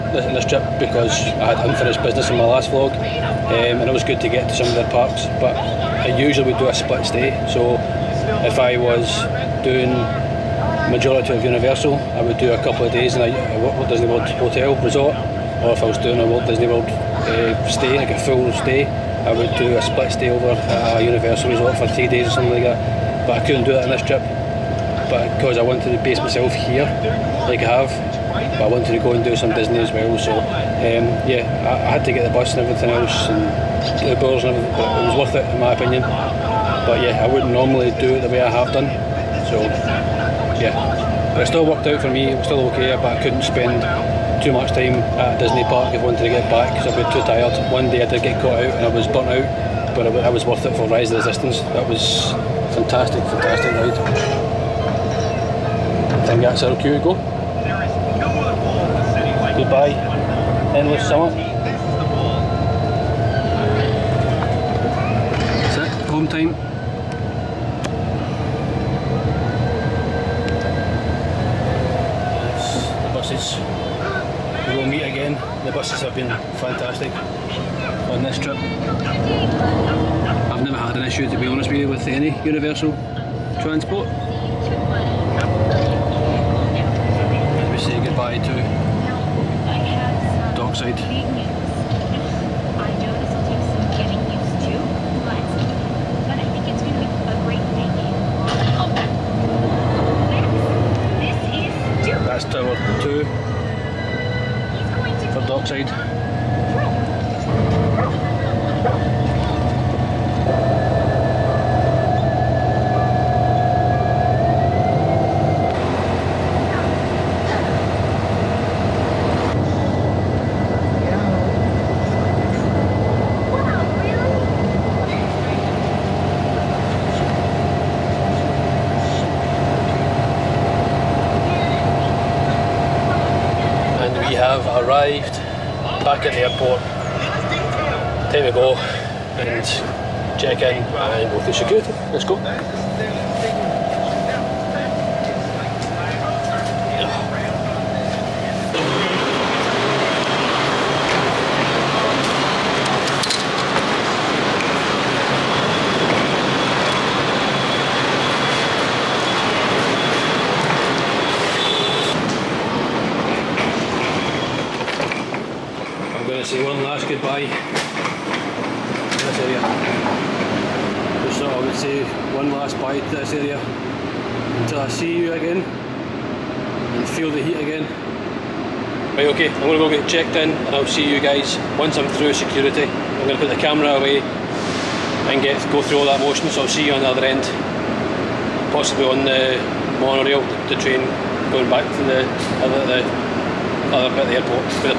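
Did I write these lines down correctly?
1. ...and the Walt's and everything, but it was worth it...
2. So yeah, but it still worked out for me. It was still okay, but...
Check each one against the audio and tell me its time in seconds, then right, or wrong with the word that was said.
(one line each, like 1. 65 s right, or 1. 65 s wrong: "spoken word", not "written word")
1. 33 s wrong: "Uber", not "Walt"
2. 39 s right.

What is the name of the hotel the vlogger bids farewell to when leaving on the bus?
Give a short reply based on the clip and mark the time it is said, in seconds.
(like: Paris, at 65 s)
Dockside, at 90 s.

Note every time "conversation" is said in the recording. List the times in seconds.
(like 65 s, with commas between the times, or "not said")
not said.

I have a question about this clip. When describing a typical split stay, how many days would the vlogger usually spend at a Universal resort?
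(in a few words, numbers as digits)
3.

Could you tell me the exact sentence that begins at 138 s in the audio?
go and check in and go through security.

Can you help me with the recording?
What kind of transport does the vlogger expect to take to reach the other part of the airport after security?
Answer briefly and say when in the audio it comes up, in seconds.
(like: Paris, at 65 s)
monorail, at 189 s.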